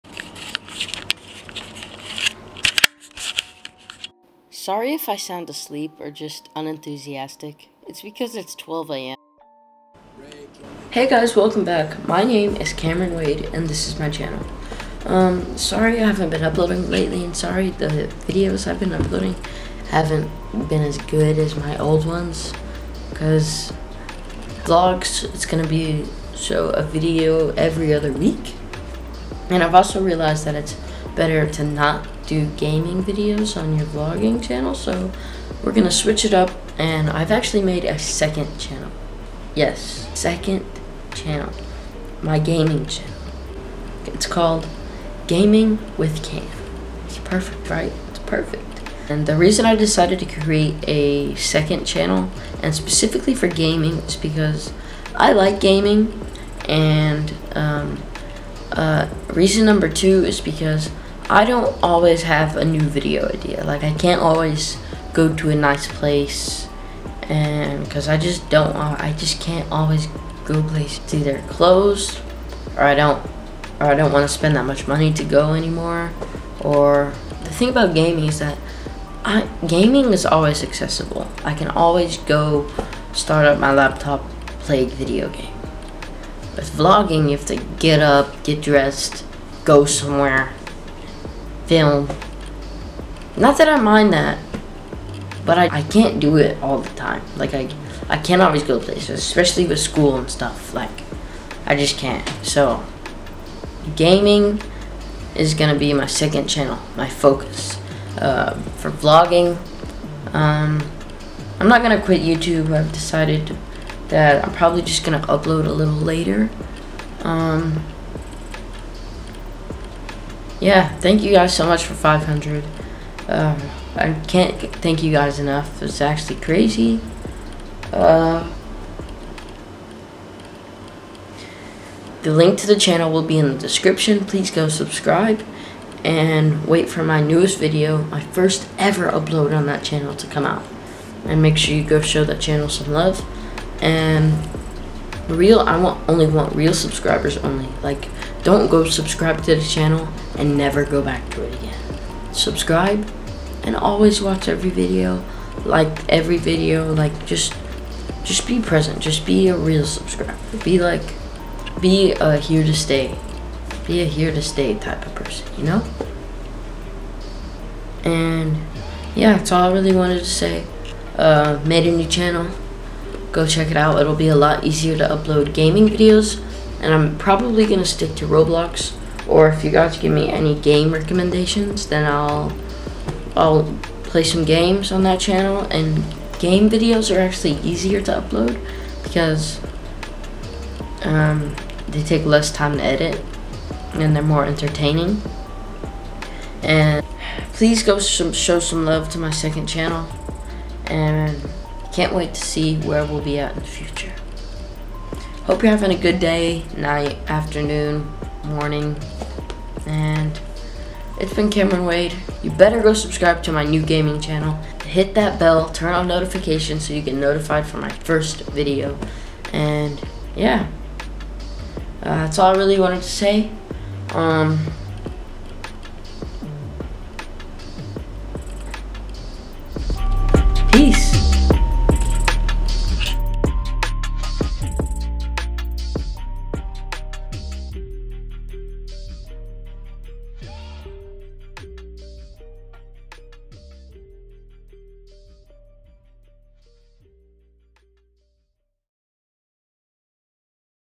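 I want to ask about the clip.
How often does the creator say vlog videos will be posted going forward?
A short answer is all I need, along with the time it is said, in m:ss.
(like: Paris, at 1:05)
every other week, at 0:27.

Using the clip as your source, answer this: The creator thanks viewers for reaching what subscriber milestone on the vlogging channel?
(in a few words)
500.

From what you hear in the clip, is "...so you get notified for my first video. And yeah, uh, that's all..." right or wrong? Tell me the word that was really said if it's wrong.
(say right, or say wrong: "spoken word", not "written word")
right.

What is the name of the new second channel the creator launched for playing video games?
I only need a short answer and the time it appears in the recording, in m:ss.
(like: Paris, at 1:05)
Gaming with Cam, at 0:45.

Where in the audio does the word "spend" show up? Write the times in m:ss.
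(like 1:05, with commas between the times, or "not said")
1:14.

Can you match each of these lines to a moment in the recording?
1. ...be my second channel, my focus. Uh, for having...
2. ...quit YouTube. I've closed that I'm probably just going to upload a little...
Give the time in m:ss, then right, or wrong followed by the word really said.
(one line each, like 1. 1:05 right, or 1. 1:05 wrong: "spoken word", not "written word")
1. 1:45 wrong: "vlogging", not "having"
2. 1:52 wrong: "decided", not "closed".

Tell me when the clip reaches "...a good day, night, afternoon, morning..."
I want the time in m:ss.
3:25.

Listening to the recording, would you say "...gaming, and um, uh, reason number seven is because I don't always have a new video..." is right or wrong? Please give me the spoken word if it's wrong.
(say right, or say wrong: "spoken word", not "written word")
wrong: "two", not "seven".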